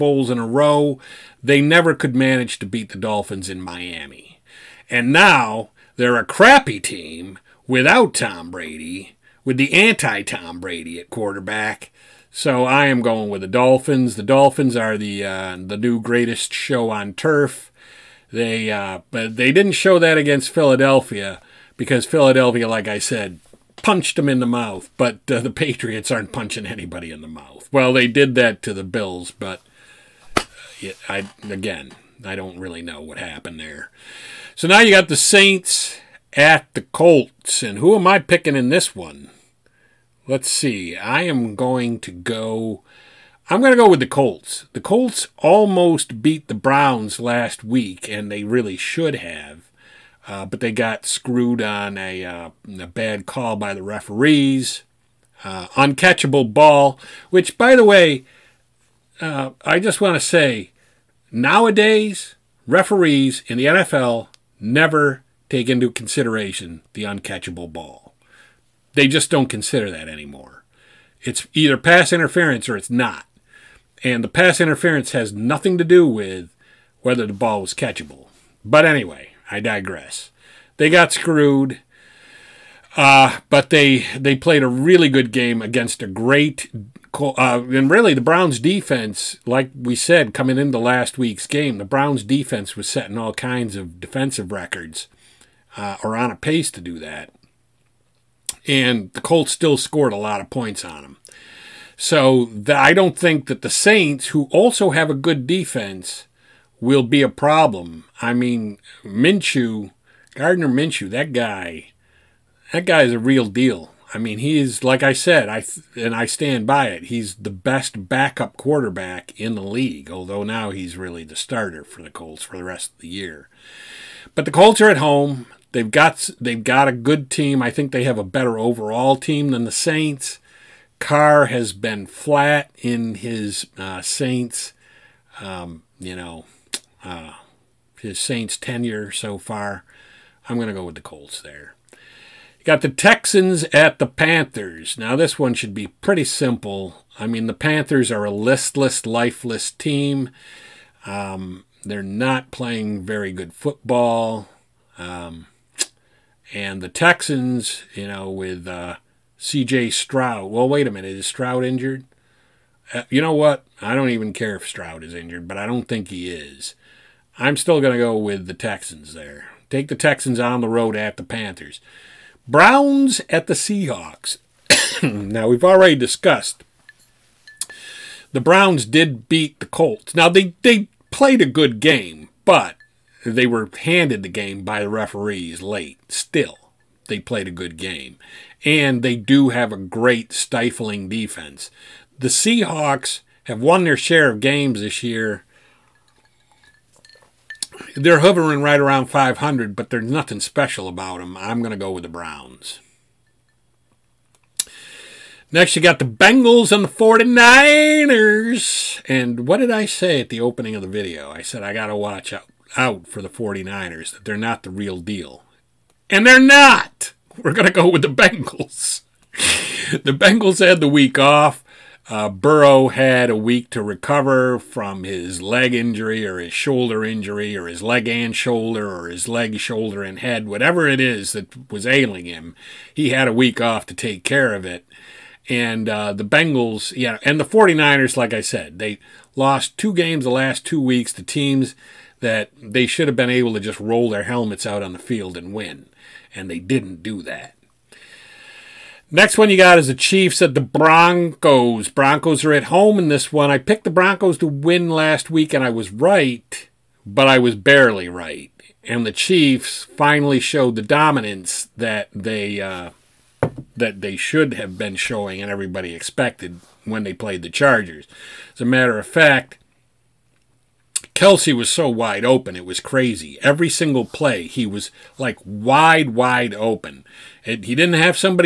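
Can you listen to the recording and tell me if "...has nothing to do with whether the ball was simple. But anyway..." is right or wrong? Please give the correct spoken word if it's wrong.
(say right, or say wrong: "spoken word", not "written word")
wrong: "catchable", not "simple".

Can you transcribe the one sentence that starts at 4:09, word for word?
Next one you got is the Chiefs at the Broncos.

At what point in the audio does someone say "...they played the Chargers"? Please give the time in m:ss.
4:27.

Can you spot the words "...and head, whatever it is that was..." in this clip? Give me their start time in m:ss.
3:50.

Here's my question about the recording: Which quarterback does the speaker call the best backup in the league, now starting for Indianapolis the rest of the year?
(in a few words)
Gardner Minshew.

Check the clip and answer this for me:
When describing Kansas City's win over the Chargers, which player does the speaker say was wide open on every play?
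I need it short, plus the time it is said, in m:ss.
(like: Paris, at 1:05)
Kelce, at 4:31.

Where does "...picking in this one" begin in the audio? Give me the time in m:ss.
0:38.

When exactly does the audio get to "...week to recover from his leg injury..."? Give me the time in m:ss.
3:43.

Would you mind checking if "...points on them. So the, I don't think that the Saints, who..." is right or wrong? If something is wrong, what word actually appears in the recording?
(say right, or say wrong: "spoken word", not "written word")
right.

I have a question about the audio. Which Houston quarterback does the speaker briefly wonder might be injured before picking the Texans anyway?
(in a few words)
C.J. Stroud.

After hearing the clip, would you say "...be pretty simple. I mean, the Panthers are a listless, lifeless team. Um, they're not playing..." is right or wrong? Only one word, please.
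right.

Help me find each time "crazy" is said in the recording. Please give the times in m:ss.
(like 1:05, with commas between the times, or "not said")
4:32.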